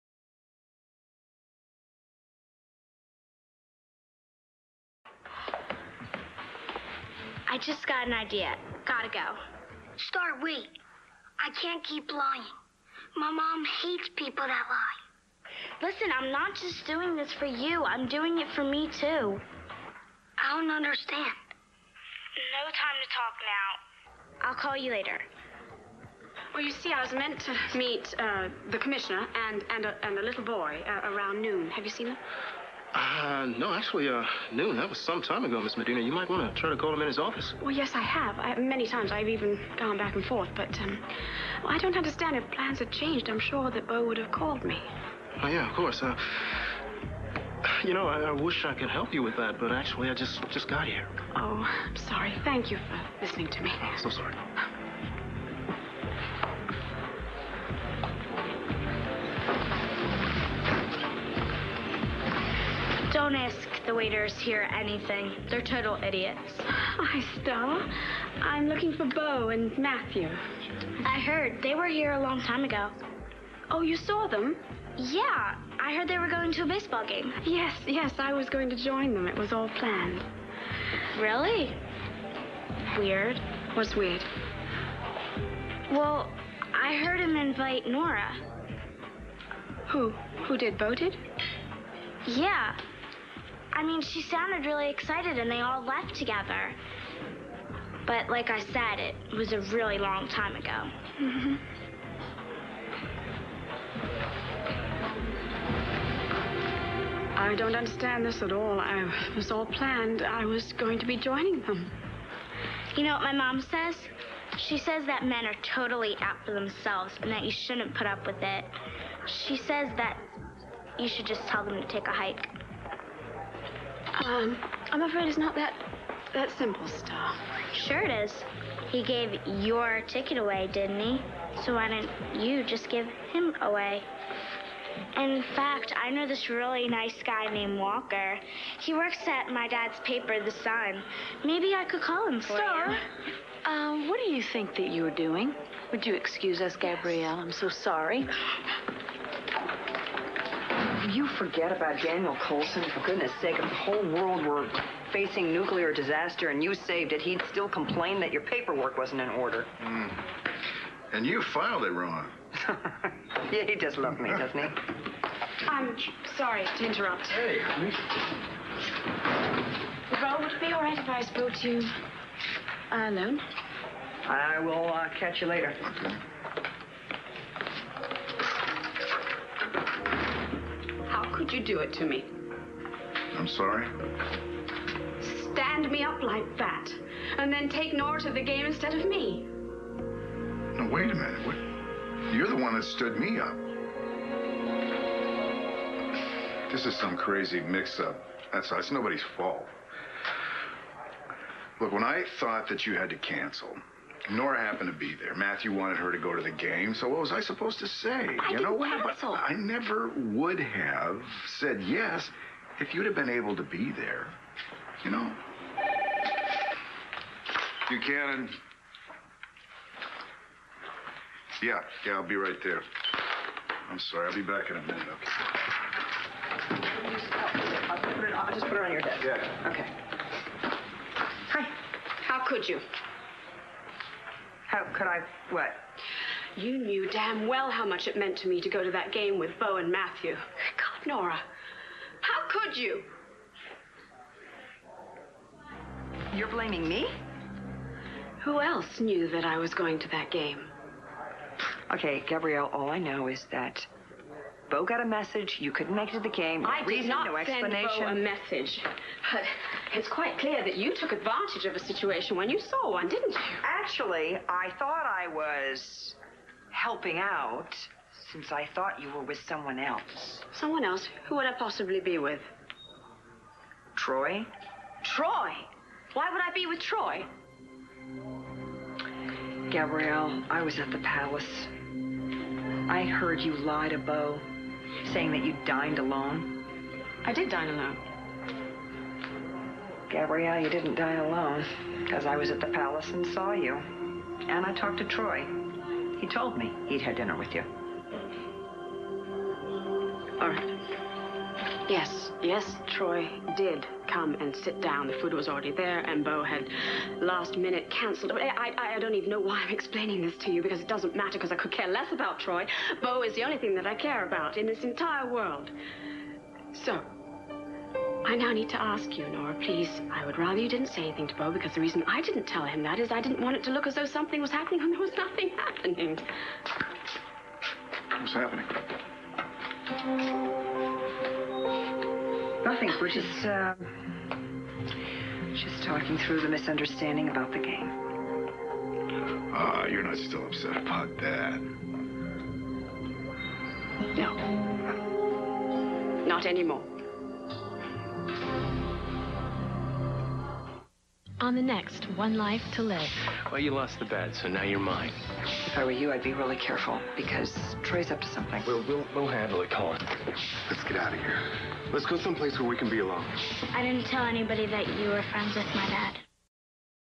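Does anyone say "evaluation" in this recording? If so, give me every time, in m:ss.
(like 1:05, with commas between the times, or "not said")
not said.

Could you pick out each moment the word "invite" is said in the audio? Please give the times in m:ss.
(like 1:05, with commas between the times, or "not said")
1:27.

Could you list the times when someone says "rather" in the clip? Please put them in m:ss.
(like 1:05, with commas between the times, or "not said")
5:20.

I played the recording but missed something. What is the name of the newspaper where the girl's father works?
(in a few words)
The Sun.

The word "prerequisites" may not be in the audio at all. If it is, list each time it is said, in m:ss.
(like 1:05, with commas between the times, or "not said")
not said.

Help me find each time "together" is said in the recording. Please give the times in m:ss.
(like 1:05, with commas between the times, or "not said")
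1:36.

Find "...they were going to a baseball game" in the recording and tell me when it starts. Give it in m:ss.
1:16.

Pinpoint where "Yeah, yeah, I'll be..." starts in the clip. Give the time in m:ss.
3:41.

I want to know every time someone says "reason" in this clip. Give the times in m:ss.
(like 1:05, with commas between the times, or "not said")
4:16, 5:21.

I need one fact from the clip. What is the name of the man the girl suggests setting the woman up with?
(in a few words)
Walker.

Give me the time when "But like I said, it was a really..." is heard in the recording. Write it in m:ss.
1:38.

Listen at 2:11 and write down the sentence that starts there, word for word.
So why didn't you just give him away?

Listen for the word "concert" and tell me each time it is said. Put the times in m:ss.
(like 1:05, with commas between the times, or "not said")
not said.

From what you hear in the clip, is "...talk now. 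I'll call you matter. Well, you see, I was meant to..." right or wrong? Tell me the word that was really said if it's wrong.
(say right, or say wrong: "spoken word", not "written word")
wrong: "later", not "matter".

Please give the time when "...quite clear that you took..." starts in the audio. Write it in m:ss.
4:20.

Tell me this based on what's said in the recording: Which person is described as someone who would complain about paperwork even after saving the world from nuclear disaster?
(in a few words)
Daniel Colson.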